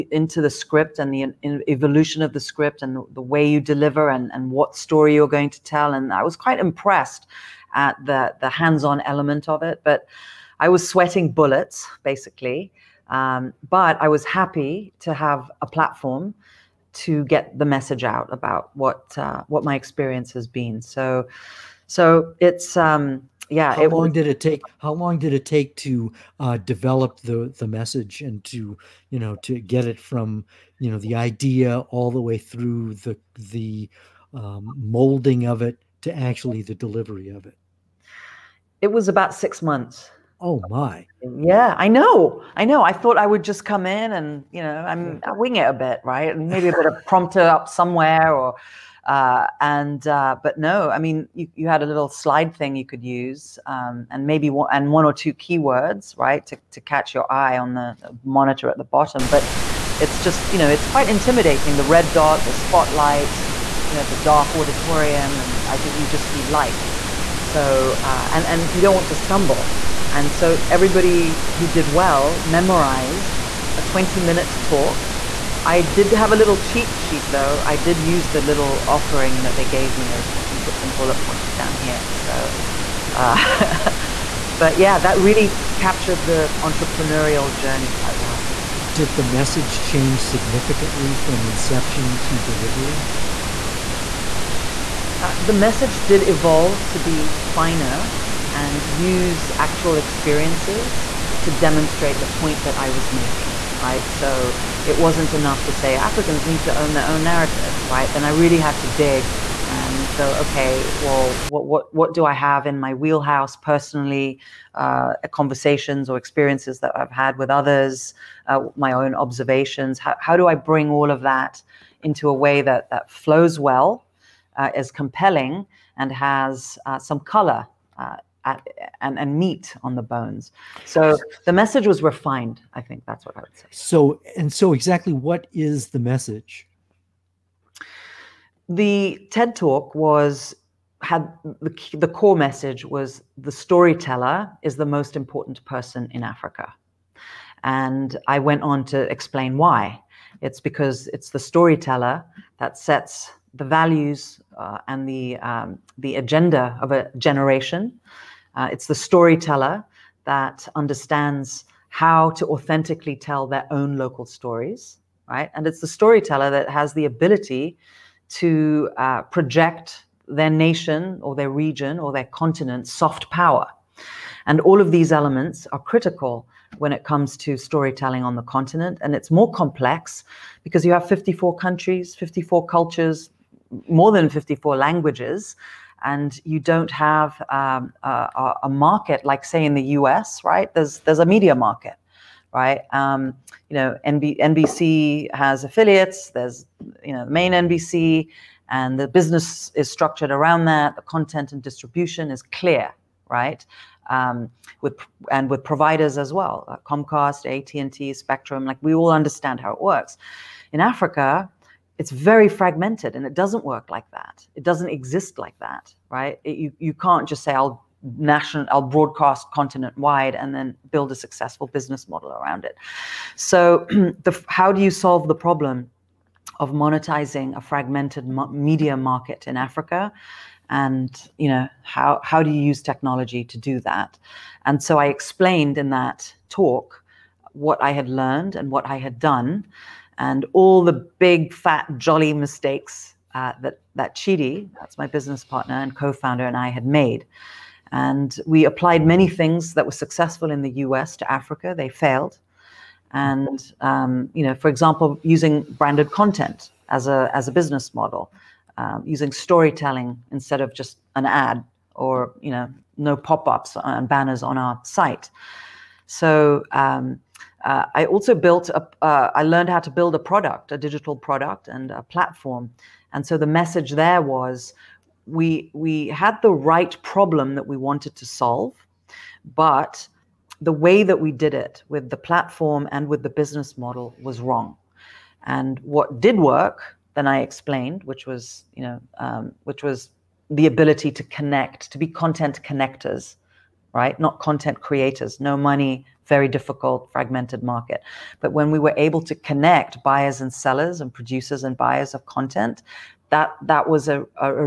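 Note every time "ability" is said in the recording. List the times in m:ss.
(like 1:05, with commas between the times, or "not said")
2:47, 4:50.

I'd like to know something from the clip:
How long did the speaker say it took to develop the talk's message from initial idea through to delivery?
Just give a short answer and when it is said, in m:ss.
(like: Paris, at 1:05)
6 months, at 0:39.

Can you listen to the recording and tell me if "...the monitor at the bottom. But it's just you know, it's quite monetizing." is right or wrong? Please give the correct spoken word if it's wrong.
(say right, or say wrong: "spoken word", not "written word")
wrong: "intimidating", not "monetizing".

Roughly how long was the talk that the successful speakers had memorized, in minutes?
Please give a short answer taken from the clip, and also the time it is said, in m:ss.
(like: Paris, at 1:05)
20 minutes, at 1:13.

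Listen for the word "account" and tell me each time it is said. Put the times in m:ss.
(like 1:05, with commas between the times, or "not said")
not said.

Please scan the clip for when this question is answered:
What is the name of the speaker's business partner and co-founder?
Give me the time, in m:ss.
4:04.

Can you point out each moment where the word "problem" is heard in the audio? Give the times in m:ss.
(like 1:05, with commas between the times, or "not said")
3:45, 4:37.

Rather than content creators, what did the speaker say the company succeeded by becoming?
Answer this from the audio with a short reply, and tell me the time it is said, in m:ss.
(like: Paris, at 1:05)
Content connectors, at 4:52.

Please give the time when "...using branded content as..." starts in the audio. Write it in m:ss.
4:15.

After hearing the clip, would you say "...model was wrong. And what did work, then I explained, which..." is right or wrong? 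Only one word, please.
right.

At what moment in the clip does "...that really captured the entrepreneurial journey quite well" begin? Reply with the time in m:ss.
1:24.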